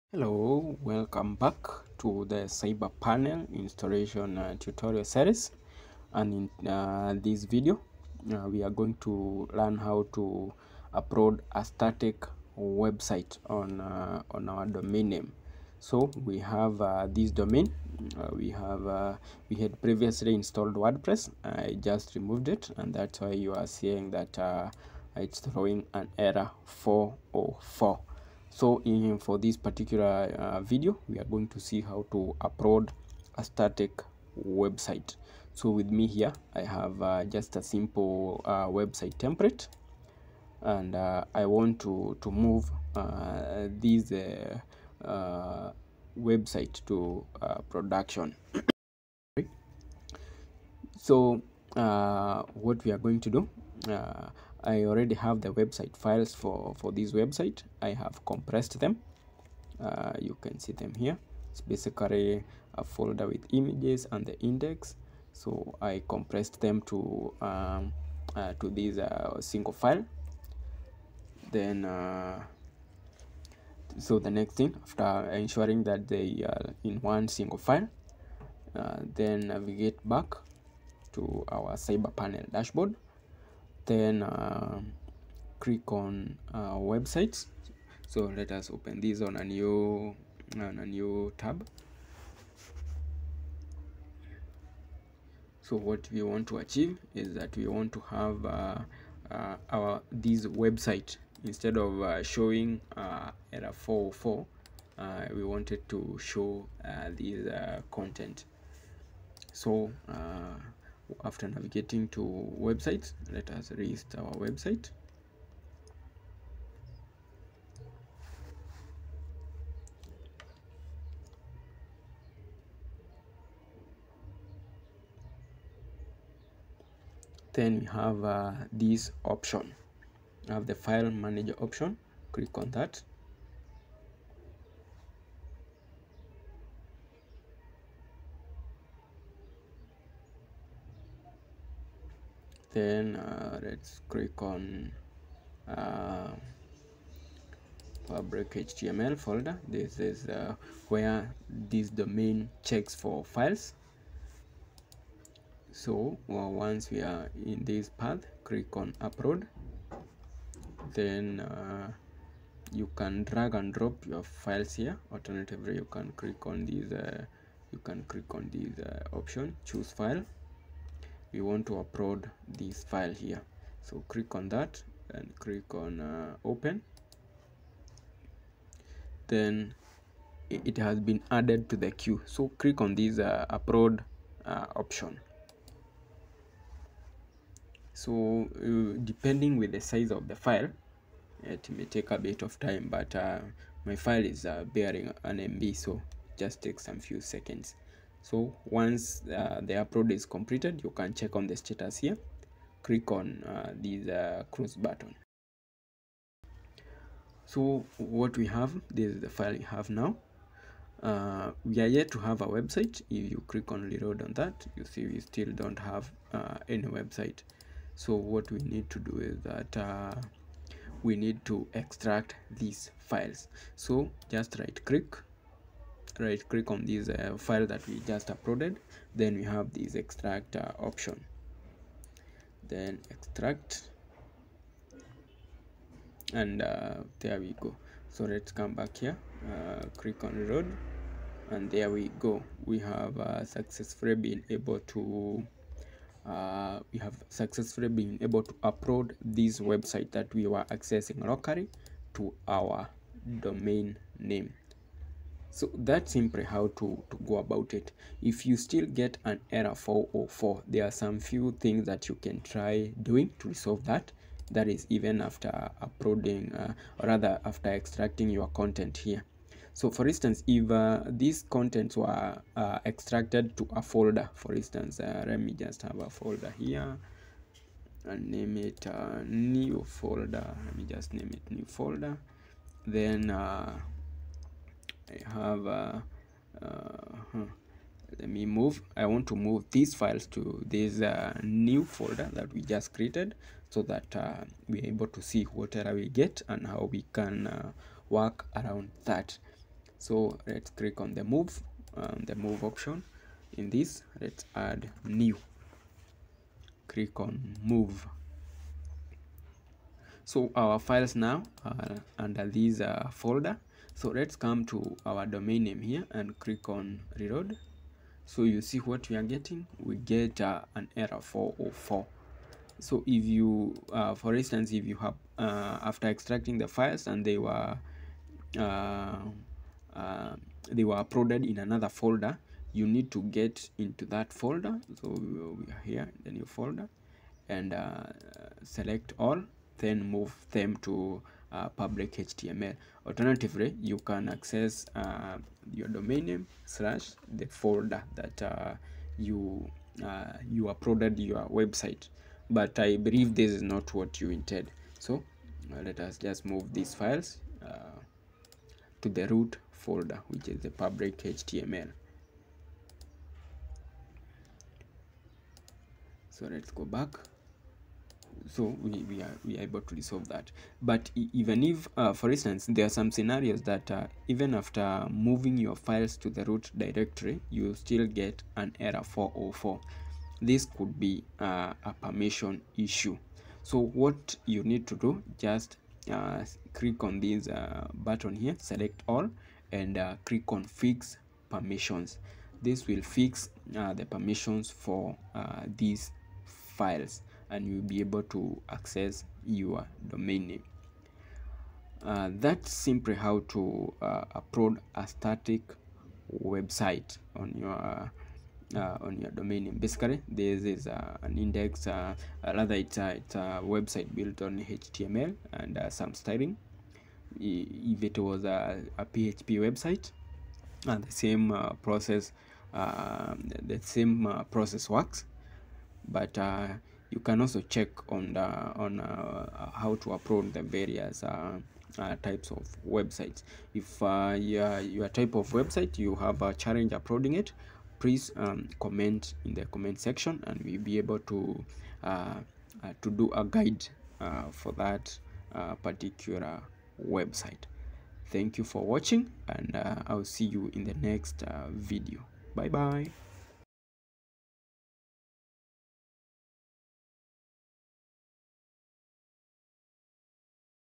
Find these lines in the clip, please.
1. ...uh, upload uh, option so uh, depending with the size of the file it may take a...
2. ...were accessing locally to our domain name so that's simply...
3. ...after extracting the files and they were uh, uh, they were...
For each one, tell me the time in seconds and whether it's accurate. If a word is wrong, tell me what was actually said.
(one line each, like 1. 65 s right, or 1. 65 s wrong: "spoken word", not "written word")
1. 183 s right
2. 250 s right
3. 325 s right.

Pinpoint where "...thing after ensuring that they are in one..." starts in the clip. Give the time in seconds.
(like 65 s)
74 s.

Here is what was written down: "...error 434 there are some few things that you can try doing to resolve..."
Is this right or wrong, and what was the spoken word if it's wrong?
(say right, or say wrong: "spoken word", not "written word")
wrong: "404", not "434".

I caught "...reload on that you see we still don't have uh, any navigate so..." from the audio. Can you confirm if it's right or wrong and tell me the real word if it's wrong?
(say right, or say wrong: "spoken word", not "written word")
wrong: "website", not "navigate".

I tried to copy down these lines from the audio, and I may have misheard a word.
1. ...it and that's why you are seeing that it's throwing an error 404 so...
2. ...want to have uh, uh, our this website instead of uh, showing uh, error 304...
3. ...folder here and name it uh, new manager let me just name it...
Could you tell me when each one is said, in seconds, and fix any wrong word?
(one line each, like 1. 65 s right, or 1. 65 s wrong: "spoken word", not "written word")
1. 22 s right
2. 97 s wrong: "404", not "304"
3. 276 s wrong: "folder", not "manager".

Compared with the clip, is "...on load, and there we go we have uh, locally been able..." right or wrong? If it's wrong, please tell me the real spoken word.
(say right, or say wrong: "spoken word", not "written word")
wrong: "successfully", not "locally".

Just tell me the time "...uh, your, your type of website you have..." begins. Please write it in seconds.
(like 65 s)
434 s.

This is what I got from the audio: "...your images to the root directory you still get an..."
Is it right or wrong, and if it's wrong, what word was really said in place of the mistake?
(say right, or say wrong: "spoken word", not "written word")
wrong: "files", not "images".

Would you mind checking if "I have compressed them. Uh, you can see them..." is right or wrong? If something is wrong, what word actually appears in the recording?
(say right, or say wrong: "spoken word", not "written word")
right.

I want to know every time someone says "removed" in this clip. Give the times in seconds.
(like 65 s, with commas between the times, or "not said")
22 s.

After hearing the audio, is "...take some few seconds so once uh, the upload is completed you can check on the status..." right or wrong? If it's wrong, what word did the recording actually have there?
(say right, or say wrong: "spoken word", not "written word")
right.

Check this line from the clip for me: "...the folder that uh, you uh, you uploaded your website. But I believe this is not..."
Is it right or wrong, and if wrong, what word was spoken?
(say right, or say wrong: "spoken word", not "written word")
right.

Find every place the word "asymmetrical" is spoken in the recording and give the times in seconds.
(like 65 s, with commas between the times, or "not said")
not said.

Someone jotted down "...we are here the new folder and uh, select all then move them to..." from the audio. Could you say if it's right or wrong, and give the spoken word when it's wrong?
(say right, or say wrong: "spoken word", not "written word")
right.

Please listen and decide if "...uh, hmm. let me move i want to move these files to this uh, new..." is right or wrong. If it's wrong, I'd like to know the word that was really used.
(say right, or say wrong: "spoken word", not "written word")
right.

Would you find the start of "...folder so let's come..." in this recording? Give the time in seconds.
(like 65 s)
313 s.